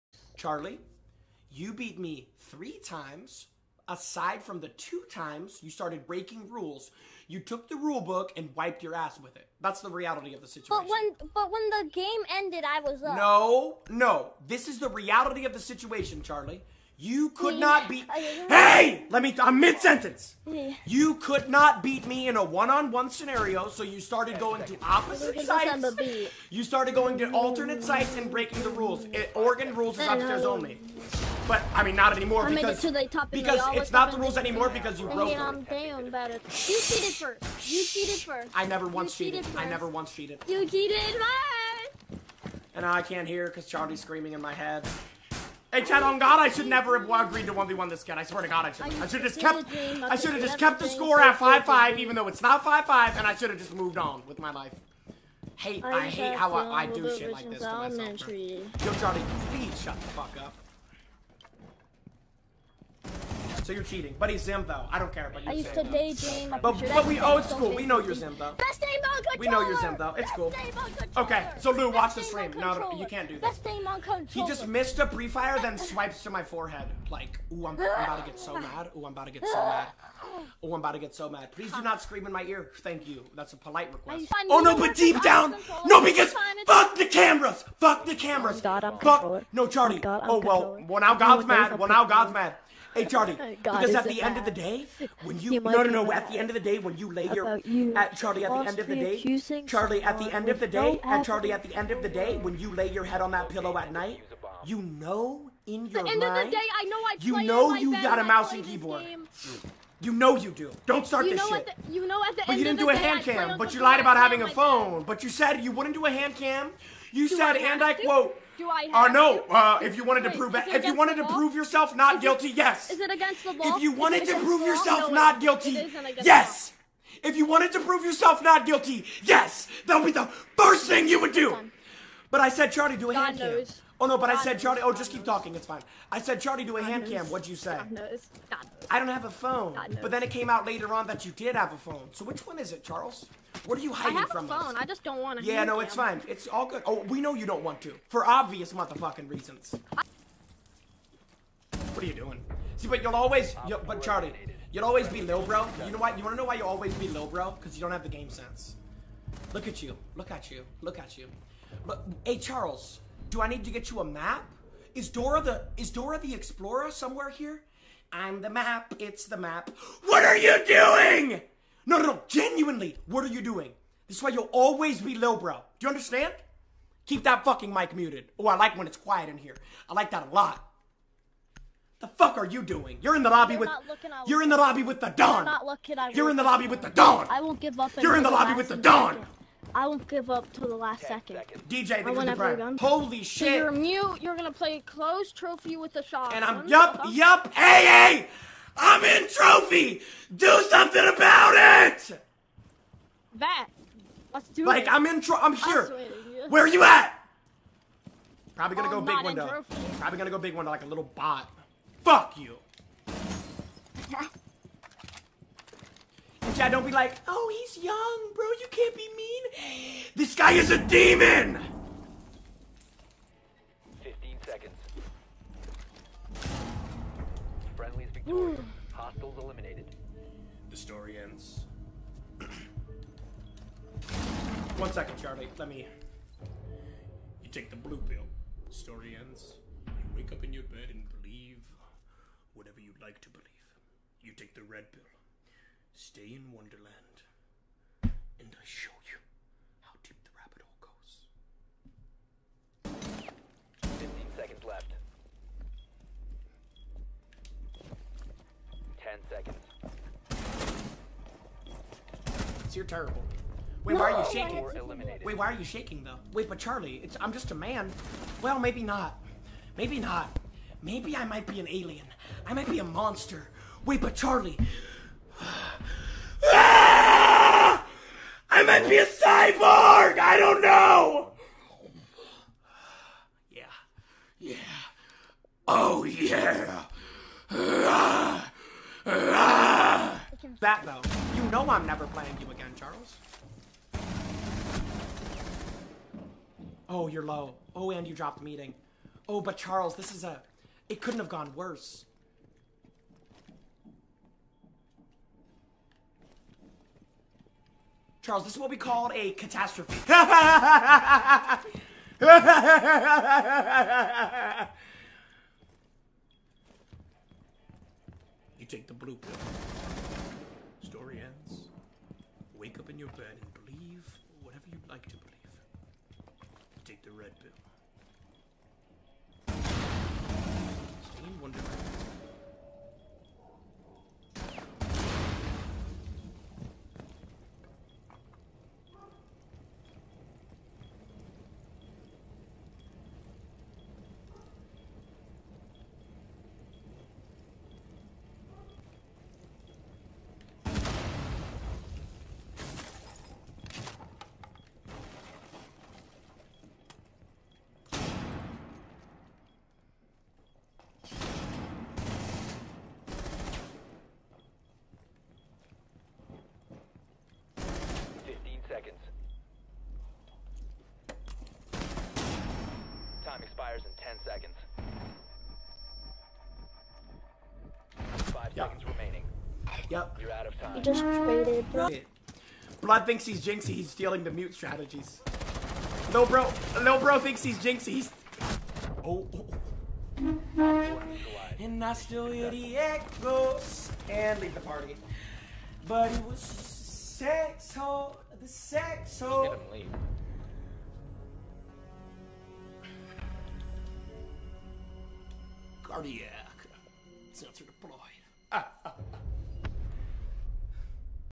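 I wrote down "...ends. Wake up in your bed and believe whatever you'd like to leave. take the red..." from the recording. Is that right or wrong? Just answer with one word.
wrong.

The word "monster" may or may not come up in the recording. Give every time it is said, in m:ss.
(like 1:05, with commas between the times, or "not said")
4:32.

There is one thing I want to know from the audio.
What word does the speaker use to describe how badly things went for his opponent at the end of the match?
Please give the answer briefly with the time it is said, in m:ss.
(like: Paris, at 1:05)
Catastrophe, at 5:09.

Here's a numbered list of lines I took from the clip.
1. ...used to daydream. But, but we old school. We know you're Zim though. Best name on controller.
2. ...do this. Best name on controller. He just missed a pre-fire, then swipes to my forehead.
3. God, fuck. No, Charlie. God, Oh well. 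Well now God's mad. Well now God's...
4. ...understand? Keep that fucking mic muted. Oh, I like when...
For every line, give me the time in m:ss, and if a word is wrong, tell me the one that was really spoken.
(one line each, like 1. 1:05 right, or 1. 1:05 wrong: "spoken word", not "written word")
1. 1:05 right
2. 1:13 right
3. 1:28 right
4. 2:55 right.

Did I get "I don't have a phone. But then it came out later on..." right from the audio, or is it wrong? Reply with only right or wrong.
right.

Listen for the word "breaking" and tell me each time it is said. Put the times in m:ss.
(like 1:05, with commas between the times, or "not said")
0:06, 0:28.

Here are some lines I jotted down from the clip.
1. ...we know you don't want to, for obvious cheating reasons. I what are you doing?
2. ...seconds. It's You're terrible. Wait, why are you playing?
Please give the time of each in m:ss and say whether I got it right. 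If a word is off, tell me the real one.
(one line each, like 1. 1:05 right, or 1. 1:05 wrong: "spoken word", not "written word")
1. 2:27 wrong: "motherfucking", not "cheating"
2. 4:20 wrong: "shaking", not "playing".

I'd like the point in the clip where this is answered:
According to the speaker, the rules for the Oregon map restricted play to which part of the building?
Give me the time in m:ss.
0:30.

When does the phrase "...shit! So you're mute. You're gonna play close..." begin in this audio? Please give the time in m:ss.
3:13.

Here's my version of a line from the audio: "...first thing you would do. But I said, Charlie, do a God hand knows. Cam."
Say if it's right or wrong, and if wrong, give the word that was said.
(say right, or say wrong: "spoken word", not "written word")
right.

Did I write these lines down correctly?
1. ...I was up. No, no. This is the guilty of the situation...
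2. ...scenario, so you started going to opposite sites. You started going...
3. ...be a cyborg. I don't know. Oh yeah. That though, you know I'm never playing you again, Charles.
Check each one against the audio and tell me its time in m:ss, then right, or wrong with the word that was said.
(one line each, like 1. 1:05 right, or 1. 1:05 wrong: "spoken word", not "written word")
1. 0:12 wrong: "reality", not "guilty"
2. 0:23 right
3. 4:38 right.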